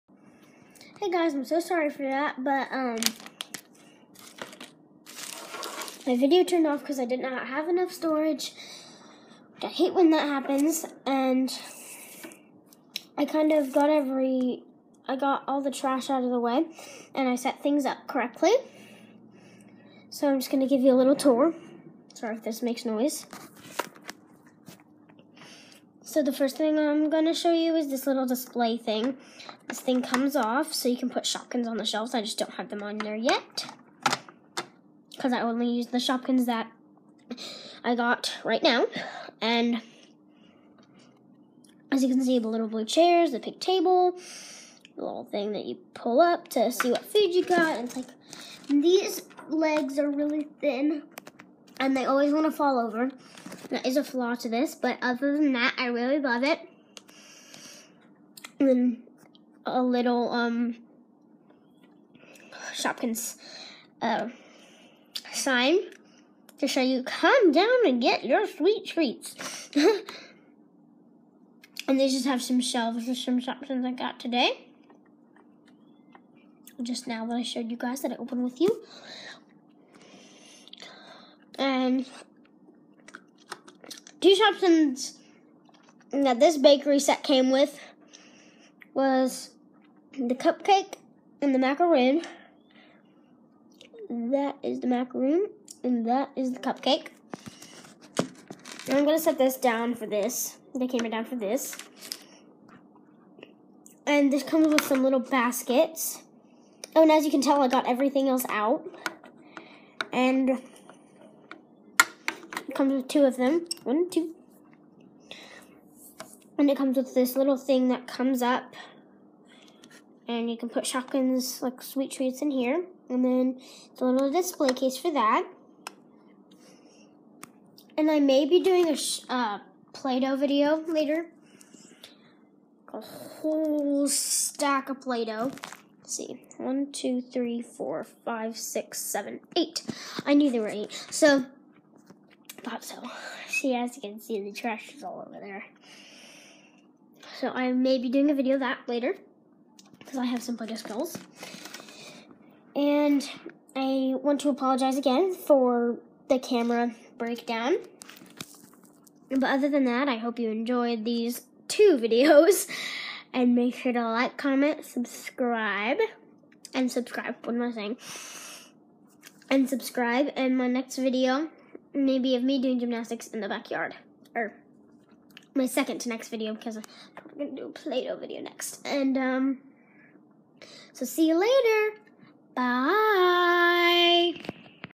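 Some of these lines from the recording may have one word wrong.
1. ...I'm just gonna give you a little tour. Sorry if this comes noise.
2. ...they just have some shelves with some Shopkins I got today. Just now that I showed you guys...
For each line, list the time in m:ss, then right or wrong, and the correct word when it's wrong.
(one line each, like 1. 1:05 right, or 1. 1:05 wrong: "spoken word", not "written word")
1. 0:20 wrong: "makes", not "comes"
2. 1:11 right.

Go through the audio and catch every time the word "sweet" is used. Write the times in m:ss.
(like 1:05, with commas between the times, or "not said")
1:08, 2:01.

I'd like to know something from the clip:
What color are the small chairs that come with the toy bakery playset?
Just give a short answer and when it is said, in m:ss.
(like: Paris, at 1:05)
Blue, at 0:42.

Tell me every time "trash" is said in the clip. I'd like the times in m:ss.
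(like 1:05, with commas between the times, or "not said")
0:15, 2:24.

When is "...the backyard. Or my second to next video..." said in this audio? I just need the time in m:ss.
2:53.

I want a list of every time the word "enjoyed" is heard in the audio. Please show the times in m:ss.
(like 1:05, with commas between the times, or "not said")
2:40.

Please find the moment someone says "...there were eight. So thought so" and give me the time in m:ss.
2:20.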